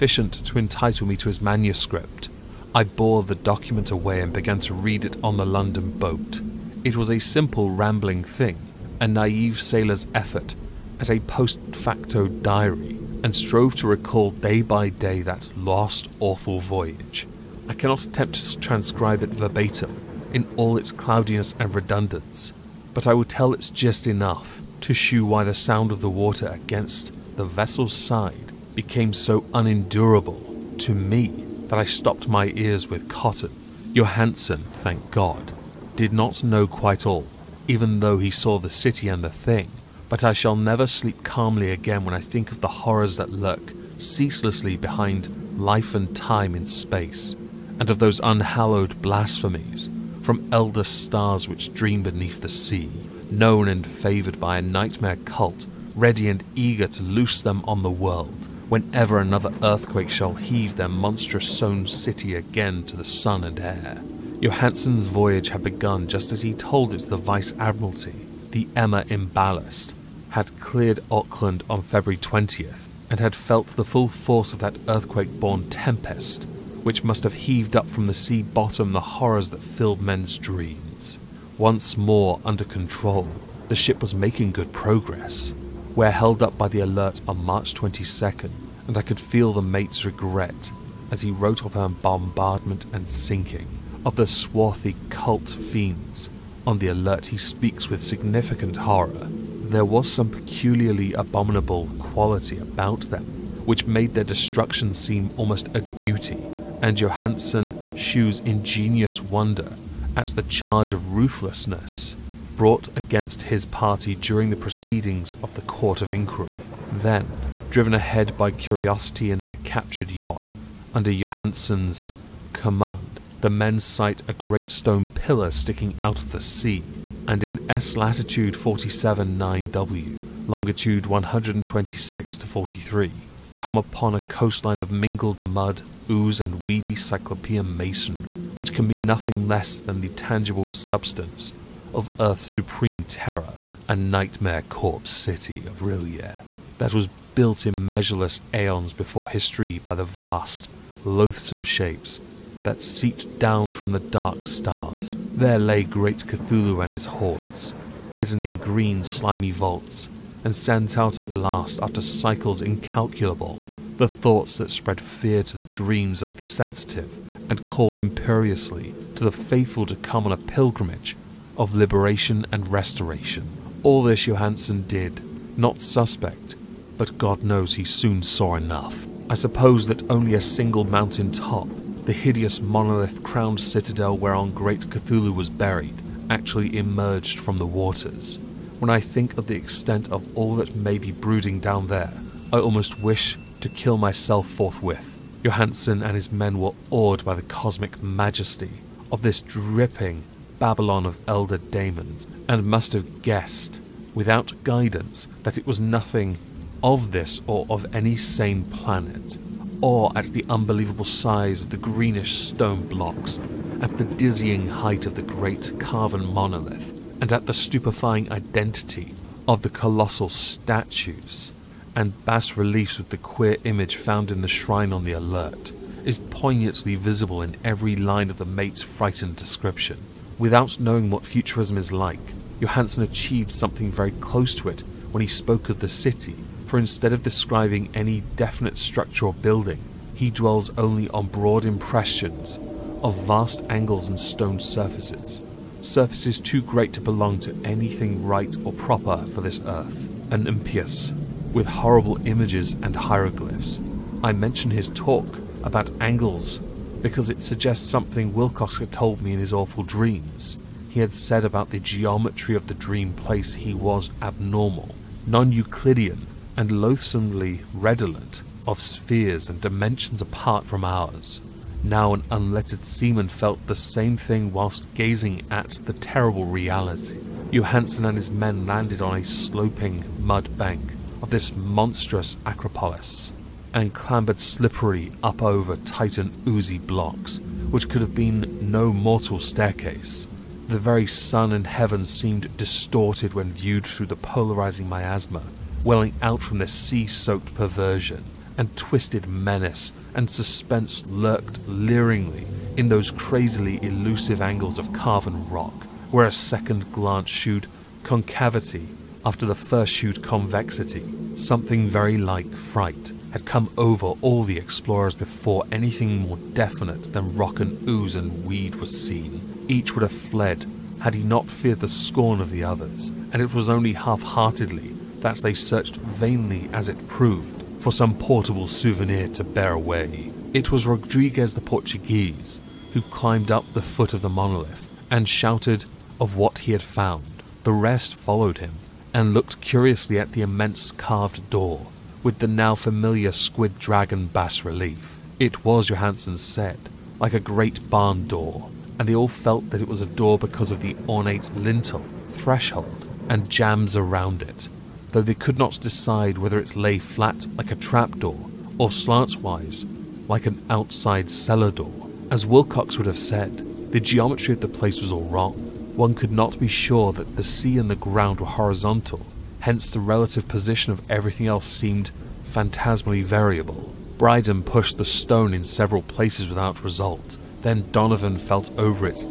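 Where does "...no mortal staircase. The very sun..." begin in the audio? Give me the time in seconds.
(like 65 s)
288 s.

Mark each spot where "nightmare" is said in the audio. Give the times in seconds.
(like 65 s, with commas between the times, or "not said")
54 s, 144 s.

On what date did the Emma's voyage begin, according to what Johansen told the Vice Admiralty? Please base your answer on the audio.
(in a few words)
February 20th.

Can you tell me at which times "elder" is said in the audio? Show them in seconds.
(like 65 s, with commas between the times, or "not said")
50 s, 201 s.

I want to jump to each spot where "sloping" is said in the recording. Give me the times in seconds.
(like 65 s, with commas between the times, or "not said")
279 s.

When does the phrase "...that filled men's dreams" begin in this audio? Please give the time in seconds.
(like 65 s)
79 s.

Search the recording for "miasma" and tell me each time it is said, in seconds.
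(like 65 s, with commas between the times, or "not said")
294 s.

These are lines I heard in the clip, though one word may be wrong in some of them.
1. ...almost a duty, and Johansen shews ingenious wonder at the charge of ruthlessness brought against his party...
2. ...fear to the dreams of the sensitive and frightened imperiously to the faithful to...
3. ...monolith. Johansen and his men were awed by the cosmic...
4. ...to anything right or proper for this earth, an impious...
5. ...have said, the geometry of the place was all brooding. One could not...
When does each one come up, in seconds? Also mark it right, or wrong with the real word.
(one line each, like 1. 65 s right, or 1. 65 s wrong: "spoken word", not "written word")
1. 105 s right
2. 164 s wrong: "called", not "frightened"
3. 194 s wrong: "forthwith", not "monolith"
4. 247 s right
5. 363 s wrong: "wrong", not "brooding".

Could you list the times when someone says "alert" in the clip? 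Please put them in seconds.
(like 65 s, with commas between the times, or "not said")
86 s, 96 s, 225 s.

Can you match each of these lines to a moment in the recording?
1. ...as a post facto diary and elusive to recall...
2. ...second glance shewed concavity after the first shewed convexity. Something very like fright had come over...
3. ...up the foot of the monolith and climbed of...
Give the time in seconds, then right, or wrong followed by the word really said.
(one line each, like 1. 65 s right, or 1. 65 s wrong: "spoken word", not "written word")
1. 11 s wrong: "strove", not "elusive"
2. 306 s right
3. 333 s wrong: "shouted", not "climbed".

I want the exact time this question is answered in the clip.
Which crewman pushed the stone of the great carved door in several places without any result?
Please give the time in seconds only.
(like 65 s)
374 s.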